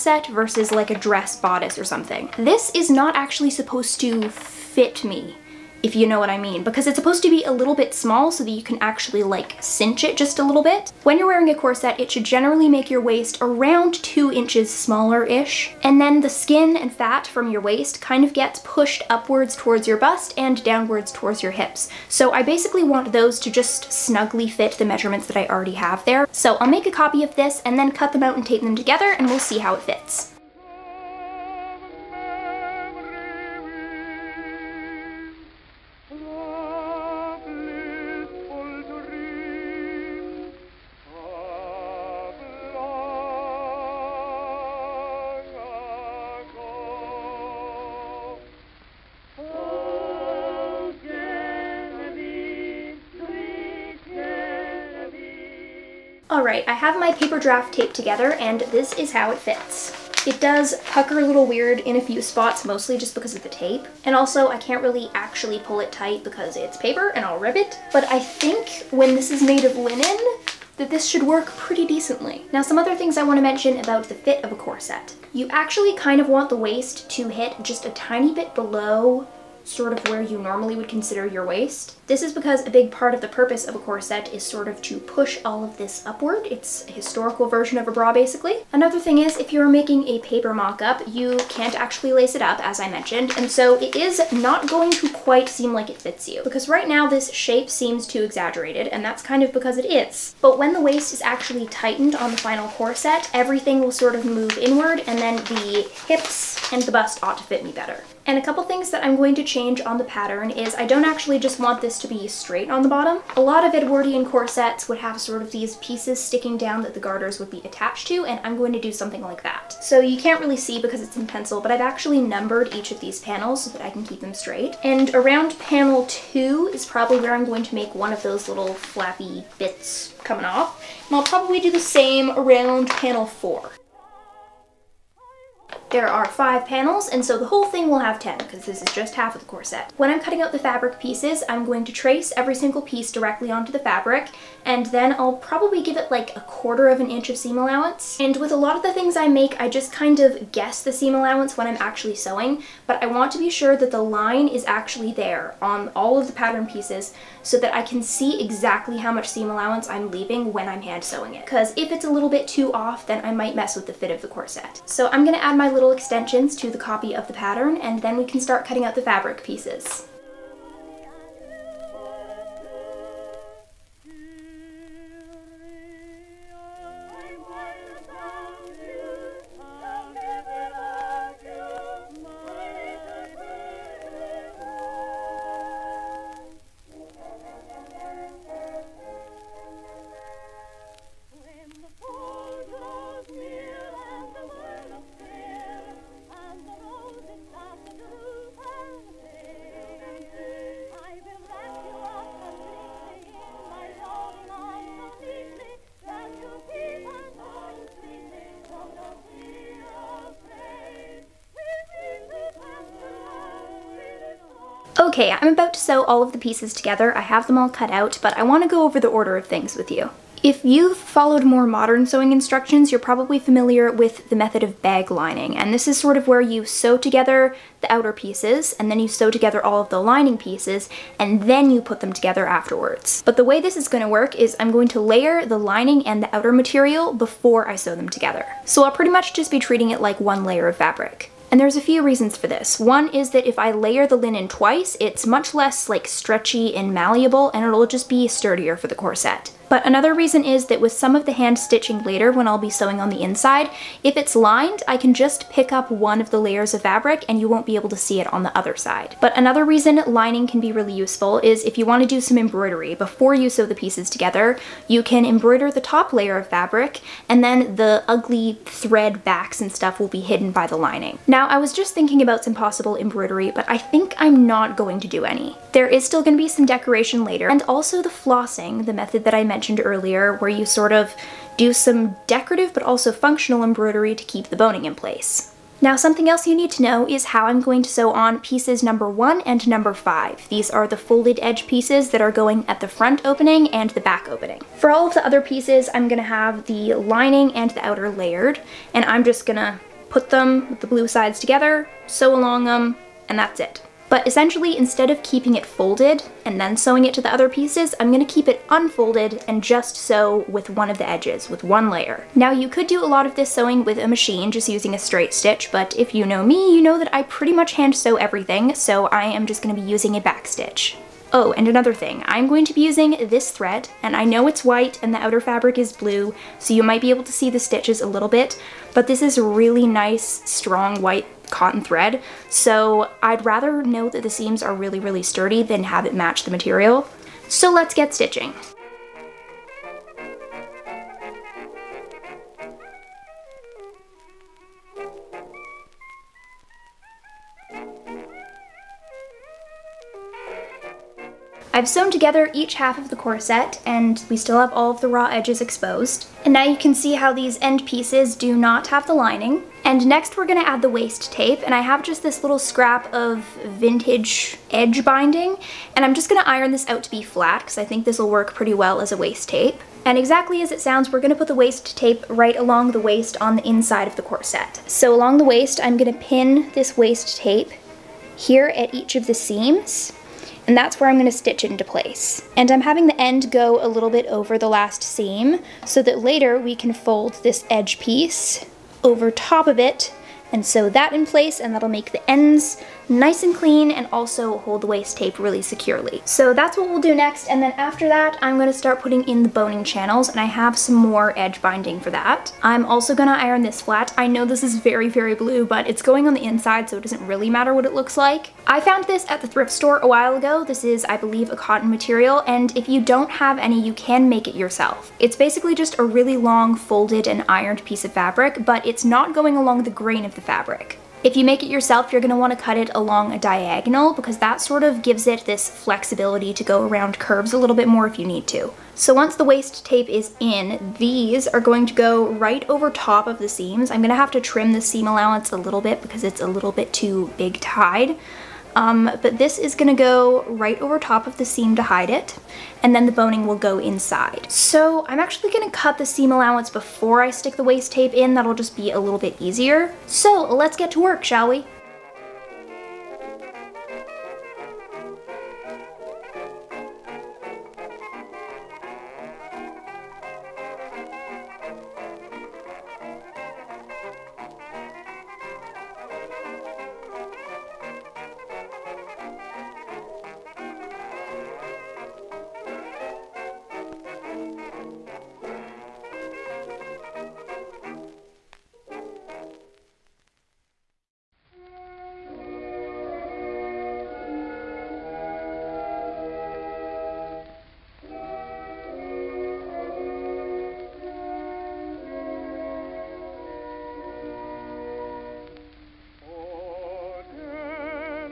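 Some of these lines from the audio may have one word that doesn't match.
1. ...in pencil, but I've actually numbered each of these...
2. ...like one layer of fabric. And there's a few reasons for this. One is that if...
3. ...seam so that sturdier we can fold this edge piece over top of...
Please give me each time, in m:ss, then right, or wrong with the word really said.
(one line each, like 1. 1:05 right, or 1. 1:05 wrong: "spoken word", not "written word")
1. 2:01 right
2. 3:59 right
3. 6:25 wrong: "later", not "sturdier".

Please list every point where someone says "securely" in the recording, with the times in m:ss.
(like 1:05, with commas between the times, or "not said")
6:35.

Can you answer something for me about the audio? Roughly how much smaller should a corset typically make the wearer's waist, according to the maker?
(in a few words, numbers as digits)
2 inches.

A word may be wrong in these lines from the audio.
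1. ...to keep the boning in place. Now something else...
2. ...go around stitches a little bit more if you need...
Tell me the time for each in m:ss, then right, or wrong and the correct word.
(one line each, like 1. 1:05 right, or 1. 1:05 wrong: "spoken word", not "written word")
1. 4:44 right
2. 7:06 wrong: "curves", not "stitches".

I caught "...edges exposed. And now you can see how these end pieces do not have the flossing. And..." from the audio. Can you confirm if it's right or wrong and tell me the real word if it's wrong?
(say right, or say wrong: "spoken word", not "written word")
wrong: "lining", not "flossing".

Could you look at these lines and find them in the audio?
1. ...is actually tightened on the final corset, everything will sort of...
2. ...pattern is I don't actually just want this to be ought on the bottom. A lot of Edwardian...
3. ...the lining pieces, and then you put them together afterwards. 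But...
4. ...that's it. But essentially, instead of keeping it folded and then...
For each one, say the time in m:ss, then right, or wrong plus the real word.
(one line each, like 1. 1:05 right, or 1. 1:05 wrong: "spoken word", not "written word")
1. 1:41 right
2. 1:50 wrong: "straight", not "ought"
3. 3:49 right
4. 5:03 right.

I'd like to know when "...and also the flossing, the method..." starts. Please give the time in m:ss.
4:37.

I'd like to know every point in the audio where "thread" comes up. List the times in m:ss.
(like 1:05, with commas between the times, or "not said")
4:28, 5:23, 5:31.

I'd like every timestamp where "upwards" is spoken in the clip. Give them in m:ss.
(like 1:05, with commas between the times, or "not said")
0:19, 1:26.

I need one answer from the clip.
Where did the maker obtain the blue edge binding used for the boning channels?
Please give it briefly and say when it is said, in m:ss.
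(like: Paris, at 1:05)
thrift store, at 6:49.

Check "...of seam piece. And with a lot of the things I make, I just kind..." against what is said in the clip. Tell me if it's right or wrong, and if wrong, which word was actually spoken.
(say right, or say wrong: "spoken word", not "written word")
wrong: "allowance", not "piece".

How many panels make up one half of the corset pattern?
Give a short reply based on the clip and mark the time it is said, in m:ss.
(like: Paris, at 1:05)
5, at 2:16.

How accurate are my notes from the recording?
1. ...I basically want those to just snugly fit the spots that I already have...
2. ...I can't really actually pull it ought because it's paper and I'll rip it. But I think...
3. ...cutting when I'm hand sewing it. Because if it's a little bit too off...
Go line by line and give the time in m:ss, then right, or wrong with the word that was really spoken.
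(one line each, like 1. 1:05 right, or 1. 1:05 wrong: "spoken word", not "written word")
1. 0:22 wrong: "measurements", not "spots"
2. 1:04 wrong: "tight", not "ought"
3. 2:40 wrong: "leaving", not "cutting".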